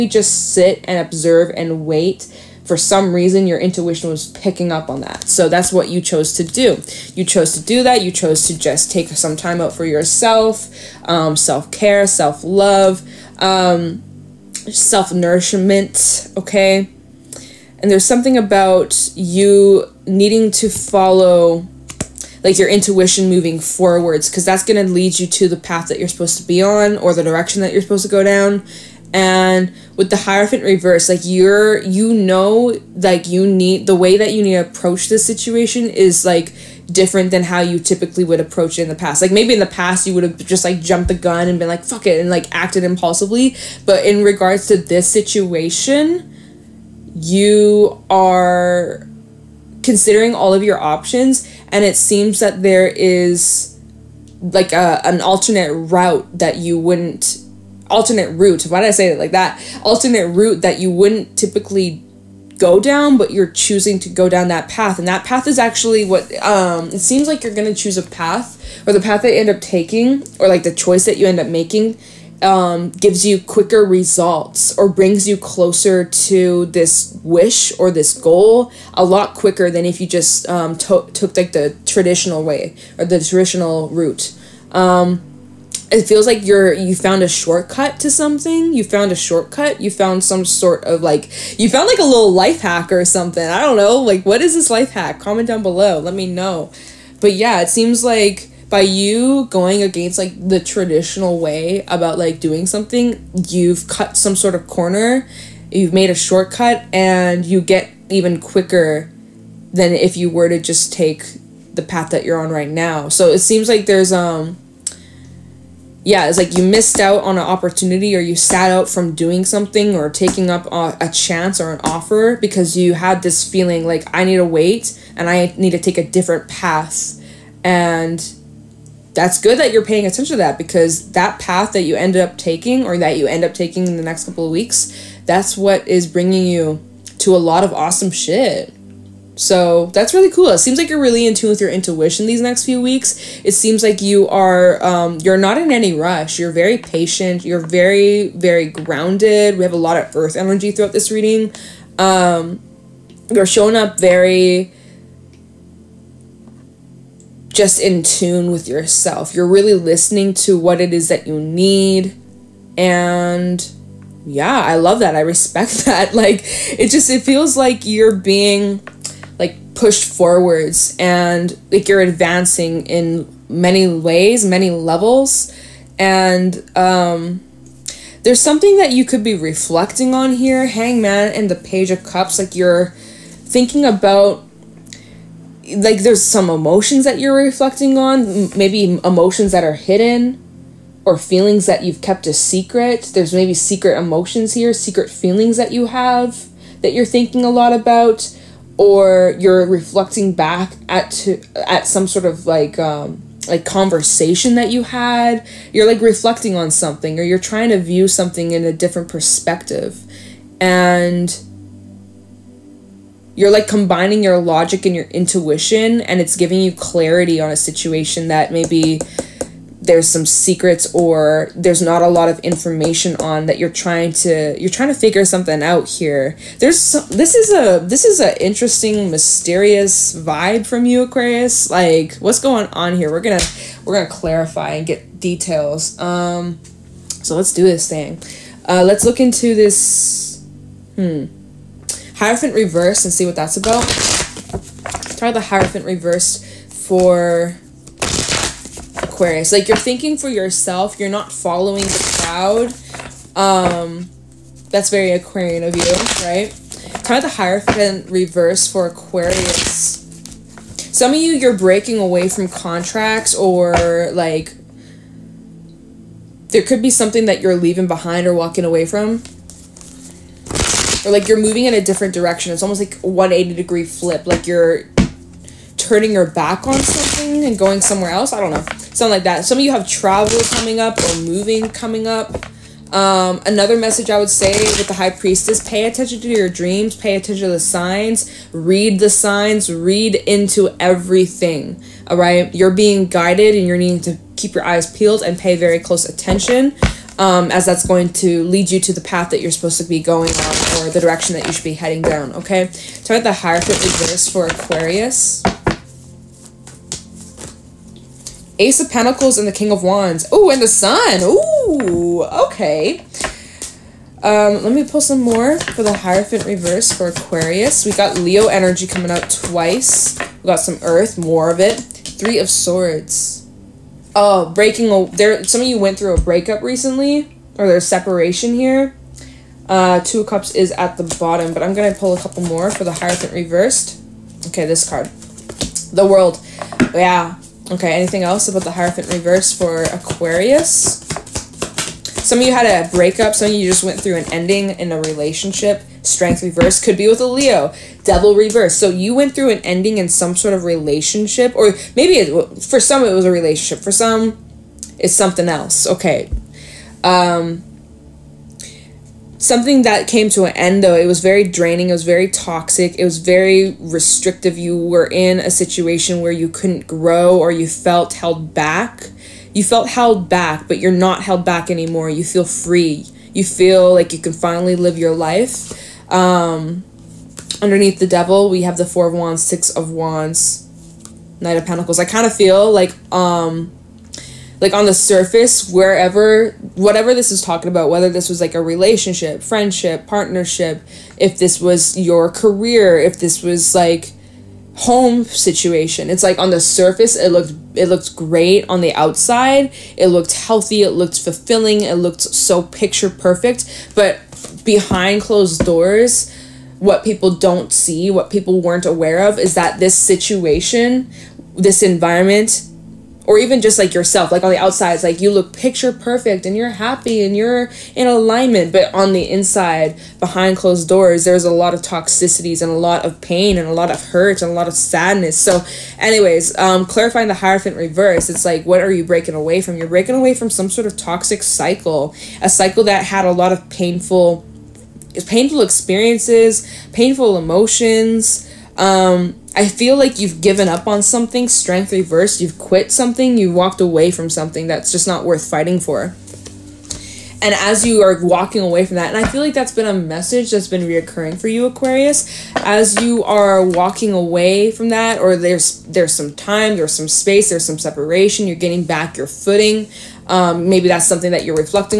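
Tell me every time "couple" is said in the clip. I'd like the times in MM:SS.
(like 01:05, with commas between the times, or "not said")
02:14, 05:32.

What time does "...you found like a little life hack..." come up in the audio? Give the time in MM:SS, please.
01:31.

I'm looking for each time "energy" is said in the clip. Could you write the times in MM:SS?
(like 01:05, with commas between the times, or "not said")
02:30, 05:18.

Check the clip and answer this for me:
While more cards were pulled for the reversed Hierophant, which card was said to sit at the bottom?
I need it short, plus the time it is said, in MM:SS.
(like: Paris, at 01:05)
Two of Cups, at 05:30.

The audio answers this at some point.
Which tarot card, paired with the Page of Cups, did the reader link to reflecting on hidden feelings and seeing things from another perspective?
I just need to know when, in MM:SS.
03:00.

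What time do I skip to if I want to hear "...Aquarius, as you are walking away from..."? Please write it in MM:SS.
07:31.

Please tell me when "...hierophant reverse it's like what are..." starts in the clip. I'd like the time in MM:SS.
07:07.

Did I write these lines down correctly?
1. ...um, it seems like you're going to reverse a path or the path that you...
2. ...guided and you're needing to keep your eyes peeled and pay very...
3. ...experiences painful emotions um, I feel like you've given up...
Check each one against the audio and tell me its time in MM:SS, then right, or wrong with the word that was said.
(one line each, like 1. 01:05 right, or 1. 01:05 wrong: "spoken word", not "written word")
1. 01:06 wrong: "choose", not "reverse"
2. 04:53 right
3. 07:15 right.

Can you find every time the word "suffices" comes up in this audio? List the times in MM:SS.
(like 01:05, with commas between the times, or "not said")
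not said.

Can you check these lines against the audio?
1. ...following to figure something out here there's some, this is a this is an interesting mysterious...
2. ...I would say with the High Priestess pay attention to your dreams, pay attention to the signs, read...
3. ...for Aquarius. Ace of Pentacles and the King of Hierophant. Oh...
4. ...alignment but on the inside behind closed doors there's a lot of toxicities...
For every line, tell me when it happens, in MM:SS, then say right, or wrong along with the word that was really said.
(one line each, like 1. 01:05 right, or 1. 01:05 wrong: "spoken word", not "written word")
1. 03:44 wrong: "trying", not "following"
2. 04:44 right
3. 05:04 wrong: "Wands", not "Hierophant"
4. 06:58 right.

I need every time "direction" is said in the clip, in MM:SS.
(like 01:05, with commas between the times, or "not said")
00:27, 04:32, 05:01.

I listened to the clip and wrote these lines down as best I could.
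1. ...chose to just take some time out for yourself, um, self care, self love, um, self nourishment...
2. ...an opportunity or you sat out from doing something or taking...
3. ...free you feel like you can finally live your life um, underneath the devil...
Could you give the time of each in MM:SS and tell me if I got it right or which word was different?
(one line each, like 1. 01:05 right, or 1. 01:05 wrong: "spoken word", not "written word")
1. 00:08 right
2. 01:57 right
3. 06:12 right.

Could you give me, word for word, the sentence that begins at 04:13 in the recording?
Um, that's very Aquarian of you, right?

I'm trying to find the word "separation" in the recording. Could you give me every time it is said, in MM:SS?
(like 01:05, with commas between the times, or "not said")
05:27, 07:37.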